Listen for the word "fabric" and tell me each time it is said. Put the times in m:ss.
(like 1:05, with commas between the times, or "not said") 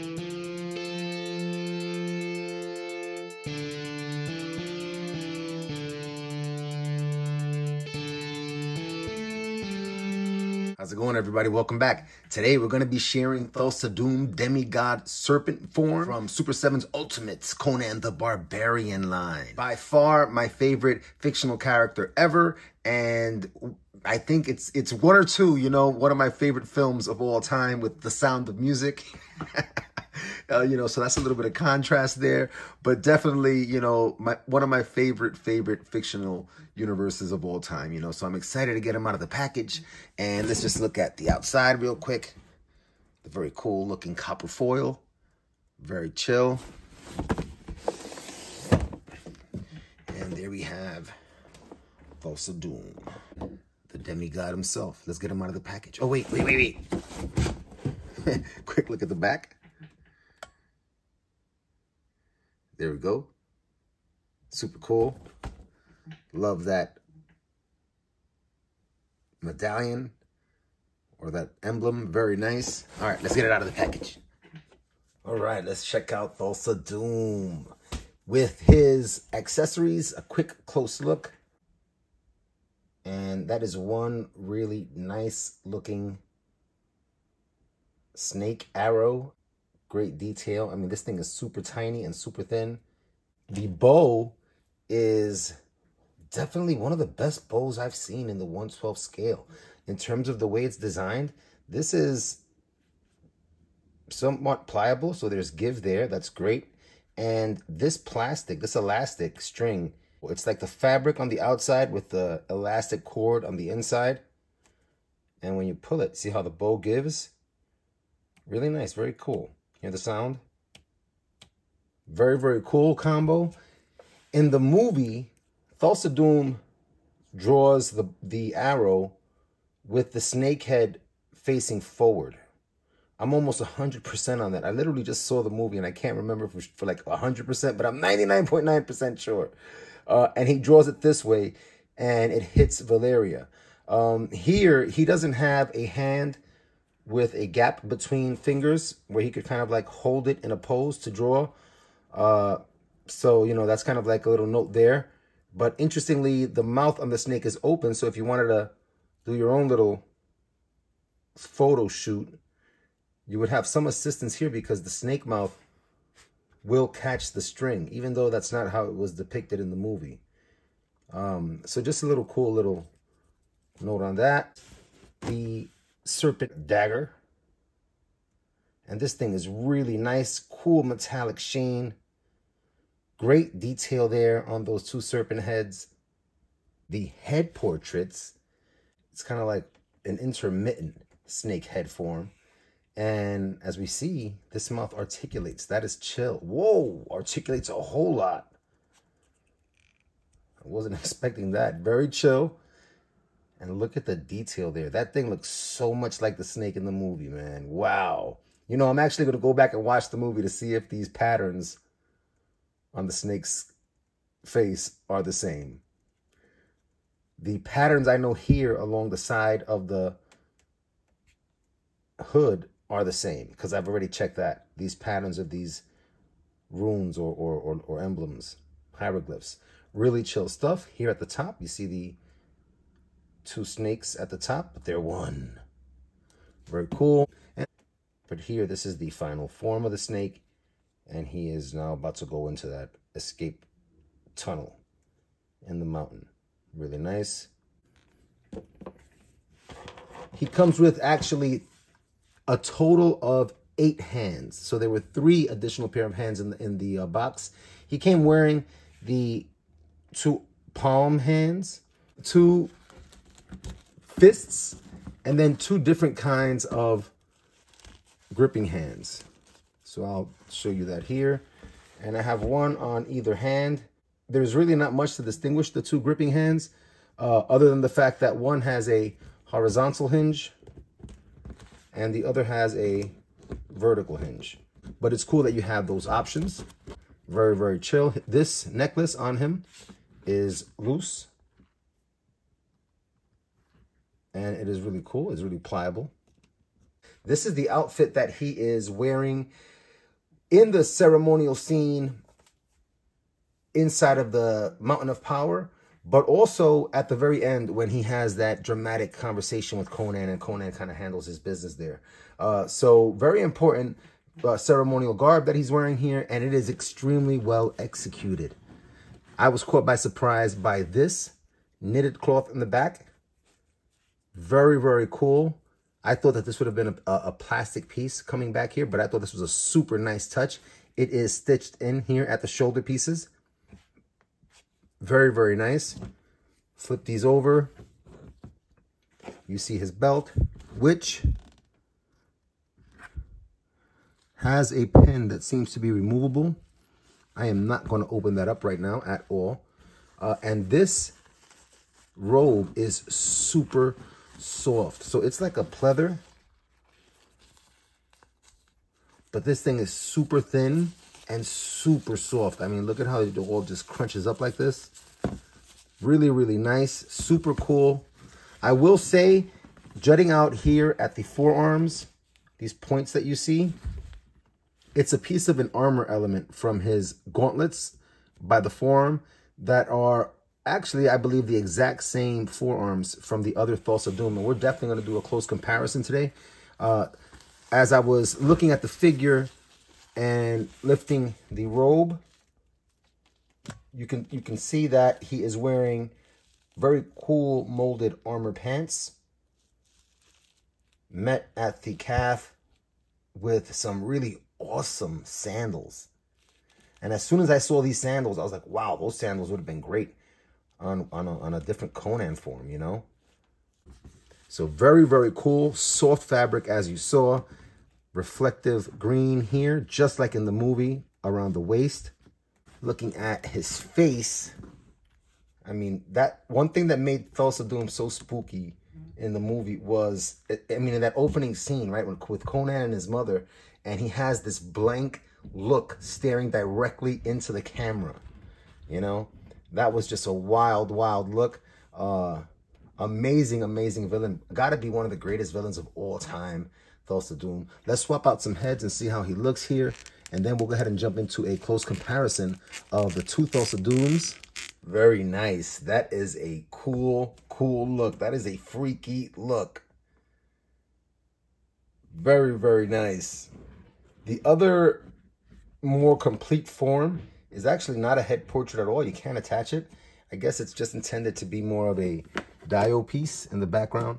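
1:50, 6:56.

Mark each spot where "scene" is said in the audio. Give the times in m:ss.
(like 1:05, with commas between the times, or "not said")
5:01, 7:11.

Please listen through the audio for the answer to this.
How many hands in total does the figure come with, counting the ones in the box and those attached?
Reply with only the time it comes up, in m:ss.
4:13.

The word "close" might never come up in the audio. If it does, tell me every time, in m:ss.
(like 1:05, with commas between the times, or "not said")
1:20, 6:25, 7:31.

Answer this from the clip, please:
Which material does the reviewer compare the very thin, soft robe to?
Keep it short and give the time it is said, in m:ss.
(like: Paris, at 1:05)
Pleather, at 5:55.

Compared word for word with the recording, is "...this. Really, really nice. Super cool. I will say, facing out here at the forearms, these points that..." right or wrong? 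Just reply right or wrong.
wrong.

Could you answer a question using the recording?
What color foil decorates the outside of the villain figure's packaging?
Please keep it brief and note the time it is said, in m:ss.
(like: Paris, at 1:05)
Copper, at 0:44.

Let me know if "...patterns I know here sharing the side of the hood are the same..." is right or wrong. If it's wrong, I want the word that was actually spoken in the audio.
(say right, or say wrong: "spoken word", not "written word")
wrong: "along", not "sharing".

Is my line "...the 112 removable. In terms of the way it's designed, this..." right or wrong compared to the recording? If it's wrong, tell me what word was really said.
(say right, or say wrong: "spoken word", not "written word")
wrong: "scale", not "removable".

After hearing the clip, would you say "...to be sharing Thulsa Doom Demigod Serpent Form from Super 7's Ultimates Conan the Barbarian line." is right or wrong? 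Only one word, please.
right.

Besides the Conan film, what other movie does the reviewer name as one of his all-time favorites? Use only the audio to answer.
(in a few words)
The Sound of Music.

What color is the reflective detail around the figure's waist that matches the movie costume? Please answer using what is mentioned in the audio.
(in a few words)
Green.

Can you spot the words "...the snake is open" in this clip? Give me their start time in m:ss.
2:37.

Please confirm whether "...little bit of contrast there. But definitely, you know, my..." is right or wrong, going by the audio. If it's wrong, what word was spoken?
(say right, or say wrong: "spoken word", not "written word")
right.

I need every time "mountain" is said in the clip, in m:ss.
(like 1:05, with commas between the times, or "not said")
4:05, 5:04.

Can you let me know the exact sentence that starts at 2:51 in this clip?
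Um, so just a little cool little note on that.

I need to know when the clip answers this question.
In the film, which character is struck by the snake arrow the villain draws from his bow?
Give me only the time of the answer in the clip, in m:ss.
2:22.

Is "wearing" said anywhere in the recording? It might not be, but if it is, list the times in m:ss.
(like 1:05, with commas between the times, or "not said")
4:18, 4:58, 5:15, 6:35.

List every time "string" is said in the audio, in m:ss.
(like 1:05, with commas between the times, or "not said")
1:49, 2:47.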